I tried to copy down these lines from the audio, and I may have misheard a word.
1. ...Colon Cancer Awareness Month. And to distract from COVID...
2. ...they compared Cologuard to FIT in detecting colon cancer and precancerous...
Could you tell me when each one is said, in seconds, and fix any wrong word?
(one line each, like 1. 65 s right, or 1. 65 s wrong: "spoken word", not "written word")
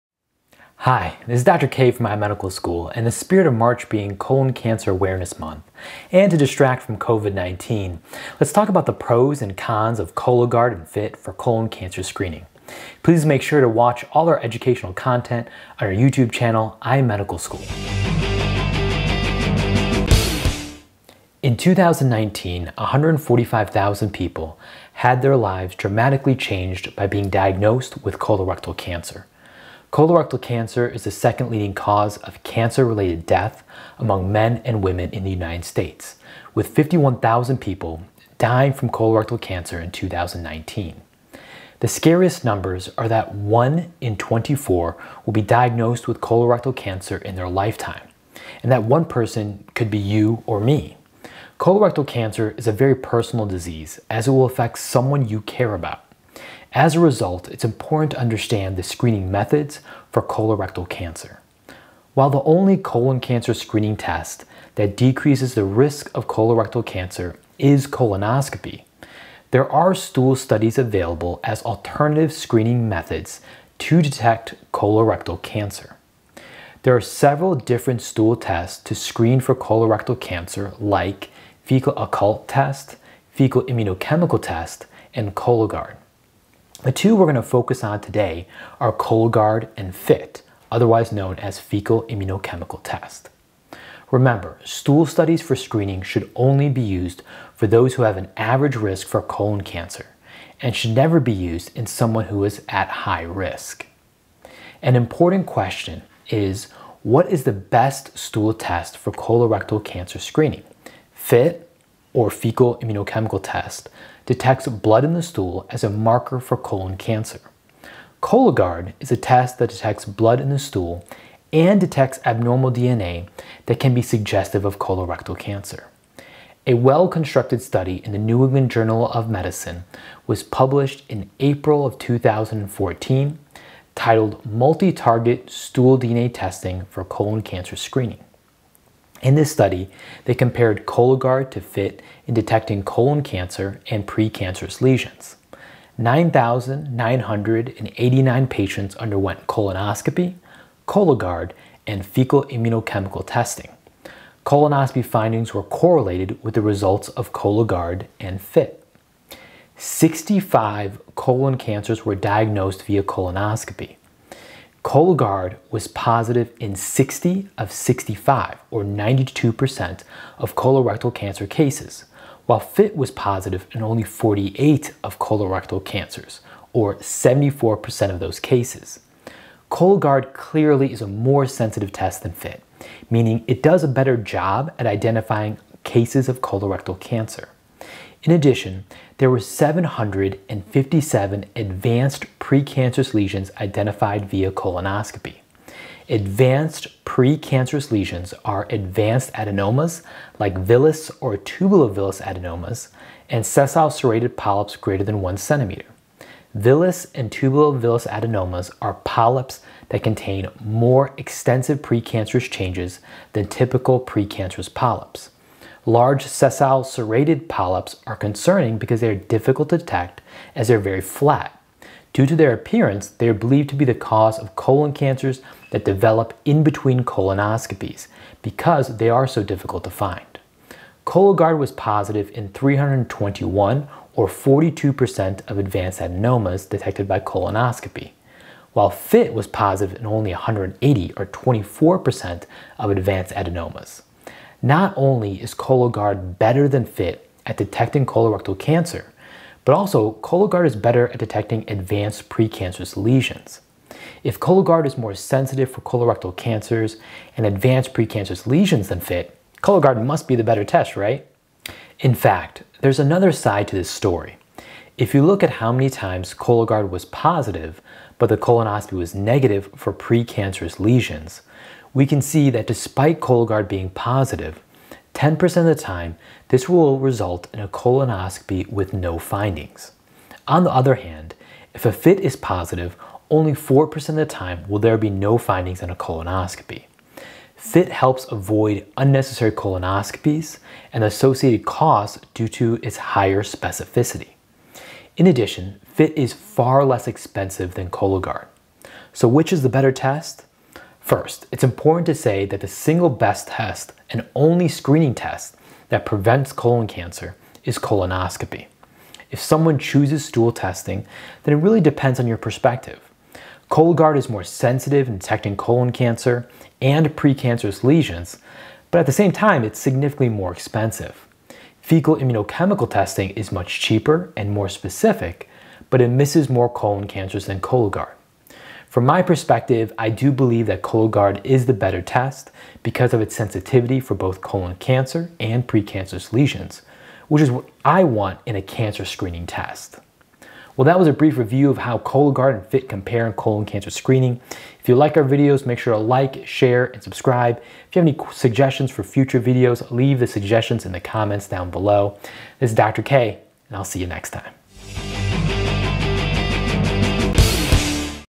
1. 4 s right
2. 140 s right.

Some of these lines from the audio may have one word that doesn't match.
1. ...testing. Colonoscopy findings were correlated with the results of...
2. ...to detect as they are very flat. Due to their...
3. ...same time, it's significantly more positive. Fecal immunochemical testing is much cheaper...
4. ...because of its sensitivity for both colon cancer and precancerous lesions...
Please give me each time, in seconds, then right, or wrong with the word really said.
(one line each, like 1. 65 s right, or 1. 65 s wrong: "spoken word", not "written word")
1. 153 s right
2. 219 s right
3. 319 s wrong: "expensive", not "positive"
4. 332 s right.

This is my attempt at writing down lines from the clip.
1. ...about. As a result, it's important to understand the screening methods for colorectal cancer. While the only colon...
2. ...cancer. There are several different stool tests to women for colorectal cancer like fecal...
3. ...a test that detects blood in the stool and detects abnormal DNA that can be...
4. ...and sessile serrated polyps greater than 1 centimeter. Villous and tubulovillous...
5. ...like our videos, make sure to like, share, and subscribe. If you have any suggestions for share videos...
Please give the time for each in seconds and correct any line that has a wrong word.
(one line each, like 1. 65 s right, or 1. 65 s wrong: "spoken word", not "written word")
1. 55 s right
2. 75 s wrong: "screen", not "women"
3. 119 s right
4. 203 s right
5. 344 s wrong: "future", not "share".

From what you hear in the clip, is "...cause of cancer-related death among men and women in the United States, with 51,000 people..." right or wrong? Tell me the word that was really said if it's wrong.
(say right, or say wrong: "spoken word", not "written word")
right.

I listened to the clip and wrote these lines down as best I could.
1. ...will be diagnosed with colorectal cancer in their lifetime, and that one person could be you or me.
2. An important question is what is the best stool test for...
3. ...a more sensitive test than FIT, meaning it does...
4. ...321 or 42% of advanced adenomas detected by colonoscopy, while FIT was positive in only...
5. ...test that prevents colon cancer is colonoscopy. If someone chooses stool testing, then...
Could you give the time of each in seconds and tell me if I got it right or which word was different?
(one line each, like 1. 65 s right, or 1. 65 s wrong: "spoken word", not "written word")
1. 45 s right
2. 104 s right
3. 181 s right
4. 232 s right
5. 305 s right.